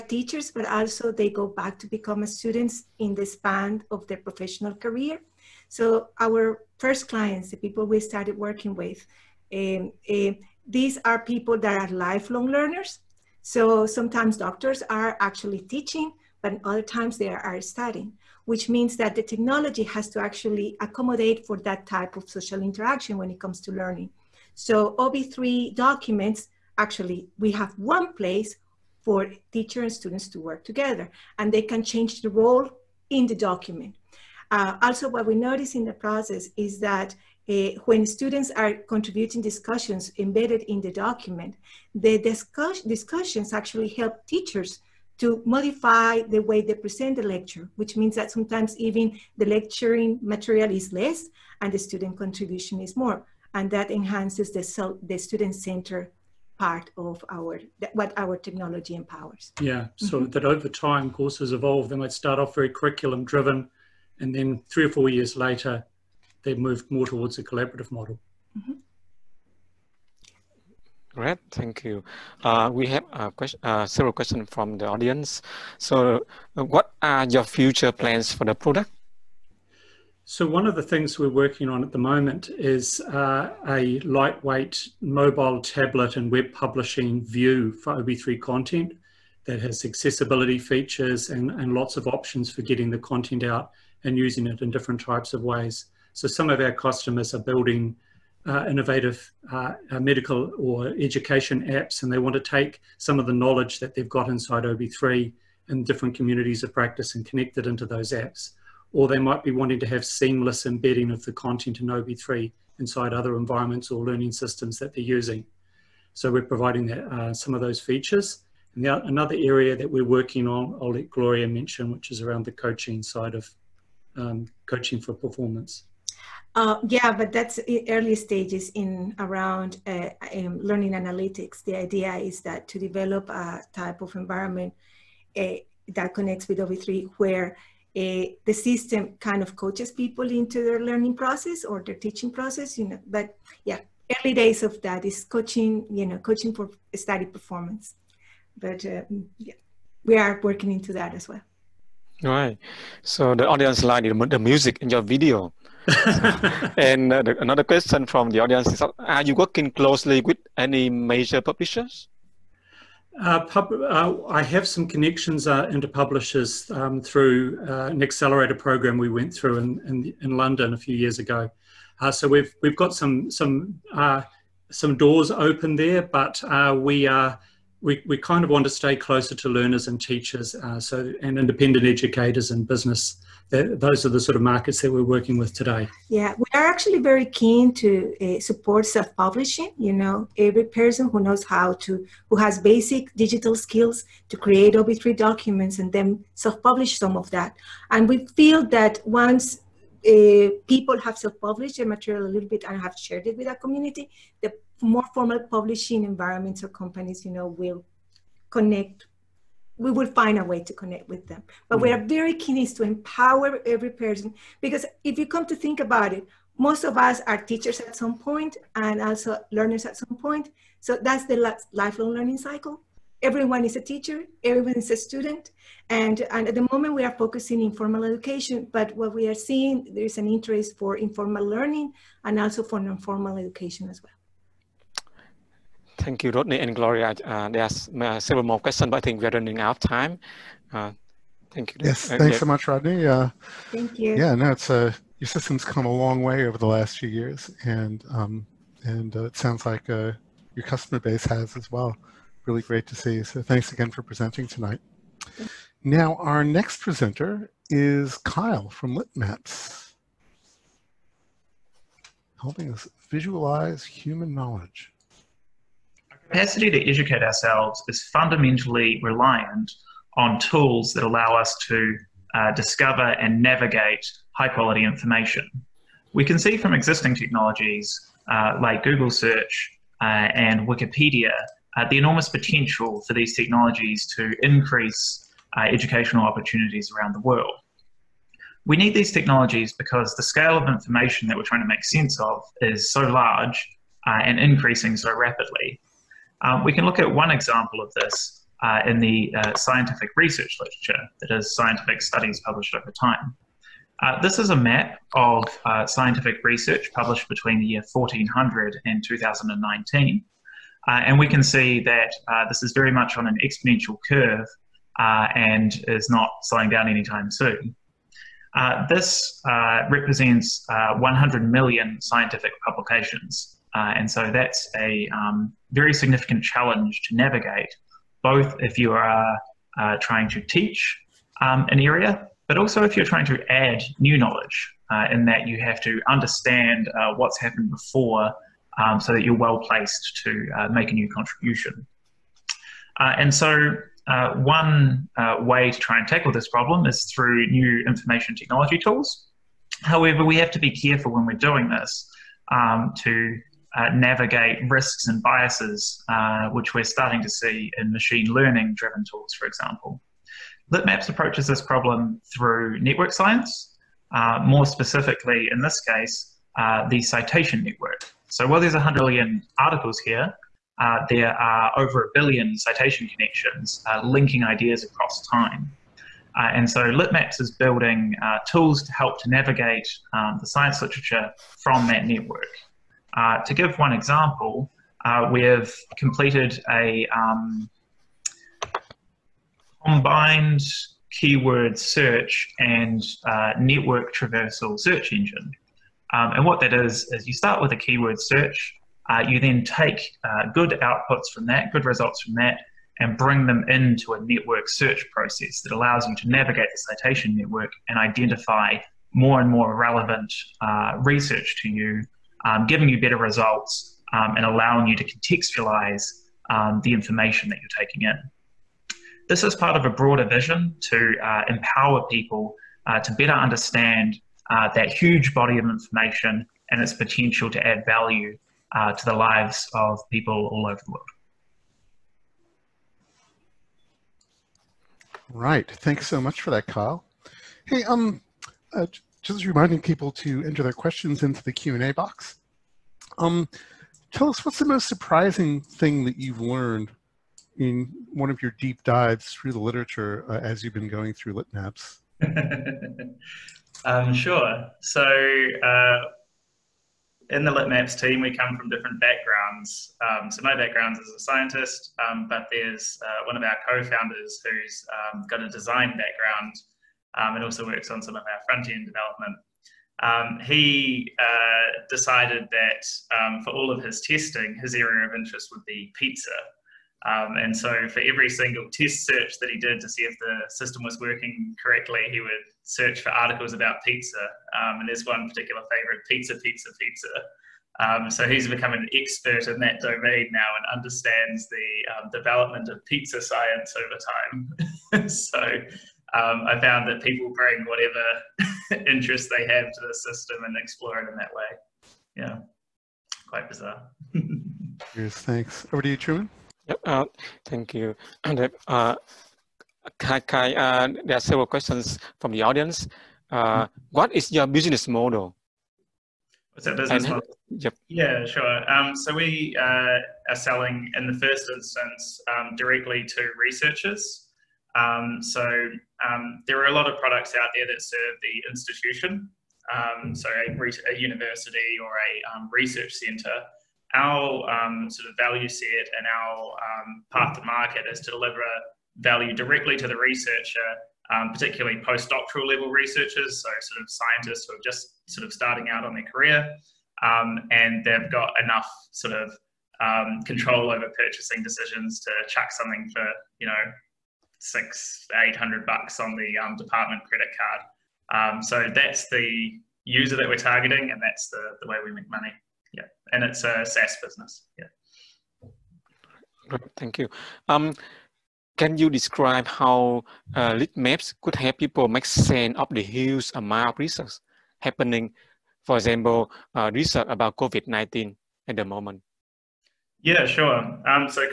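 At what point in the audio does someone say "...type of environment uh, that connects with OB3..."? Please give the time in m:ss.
2:13.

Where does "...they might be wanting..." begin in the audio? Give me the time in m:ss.
1:49.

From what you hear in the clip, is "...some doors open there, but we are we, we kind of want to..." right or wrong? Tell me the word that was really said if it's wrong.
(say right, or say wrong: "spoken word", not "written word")
right.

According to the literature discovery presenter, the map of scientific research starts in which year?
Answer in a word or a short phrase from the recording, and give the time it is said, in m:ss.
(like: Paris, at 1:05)
1400, at 5:07.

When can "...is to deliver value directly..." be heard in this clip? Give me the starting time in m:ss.
8:57.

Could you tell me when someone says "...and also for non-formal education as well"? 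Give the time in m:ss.
3:52.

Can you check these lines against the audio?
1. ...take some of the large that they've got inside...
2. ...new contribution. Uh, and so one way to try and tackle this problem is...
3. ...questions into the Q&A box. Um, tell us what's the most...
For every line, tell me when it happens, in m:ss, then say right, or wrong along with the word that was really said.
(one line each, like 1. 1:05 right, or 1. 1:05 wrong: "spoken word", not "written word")
1. 1:42 wrong: "knowledge", not "large"
2. 5:40 right
3. 7:20 right.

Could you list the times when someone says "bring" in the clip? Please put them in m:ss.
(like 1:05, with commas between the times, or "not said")
6:43, 8:17.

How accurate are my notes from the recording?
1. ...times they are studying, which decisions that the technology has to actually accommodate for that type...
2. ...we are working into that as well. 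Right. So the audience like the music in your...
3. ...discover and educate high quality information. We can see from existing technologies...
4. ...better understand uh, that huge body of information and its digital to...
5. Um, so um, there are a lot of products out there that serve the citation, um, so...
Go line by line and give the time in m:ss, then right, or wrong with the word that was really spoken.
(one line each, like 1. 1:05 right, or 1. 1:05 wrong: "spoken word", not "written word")
1. 0:16 wrong: "means", not "decisions"
2. 2:30 right
3. 4:32 wrong: "navigate", not "educate"
4. 7:03 wrong: "potential", not "digital"
5. 8:44 wrong: "institution", not "citation".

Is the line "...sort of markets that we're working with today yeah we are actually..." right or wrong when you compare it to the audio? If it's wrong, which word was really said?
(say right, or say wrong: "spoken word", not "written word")
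right.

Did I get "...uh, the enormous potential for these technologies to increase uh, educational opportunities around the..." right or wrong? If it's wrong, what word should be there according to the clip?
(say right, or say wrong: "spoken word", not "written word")
right.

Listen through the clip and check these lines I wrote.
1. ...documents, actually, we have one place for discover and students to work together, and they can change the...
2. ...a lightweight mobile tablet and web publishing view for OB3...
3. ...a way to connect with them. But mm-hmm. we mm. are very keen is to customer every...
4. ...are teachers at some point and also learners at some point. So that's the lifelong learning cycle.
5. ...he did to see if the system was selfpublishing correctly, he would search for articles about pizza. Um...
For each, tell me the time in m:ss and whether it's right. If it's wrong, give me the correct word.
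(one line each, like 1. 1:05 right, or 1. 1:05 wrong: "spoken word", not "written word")
1. 0:25 wrong: "teacher", not "discover"
2. 1:23 right
3. 3:30 wrong: "empower", not "customer"
4. 3:37 right
5. 7:59 wrong: "working", not "selfpublishing".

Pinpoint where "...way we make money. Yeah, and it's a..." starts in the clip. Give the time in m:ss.
9:21.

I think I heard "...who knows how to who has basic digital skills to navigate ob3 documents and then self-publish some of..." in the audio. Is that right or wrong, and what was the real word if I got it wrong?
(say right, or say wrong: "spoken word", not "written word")
wrong: "create", not "navigate".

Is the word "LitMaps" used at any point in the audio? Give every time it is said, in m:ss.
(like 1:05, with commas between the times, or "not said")
4:18, 6:00, 6:16, 7:31, 7:37, 9:30.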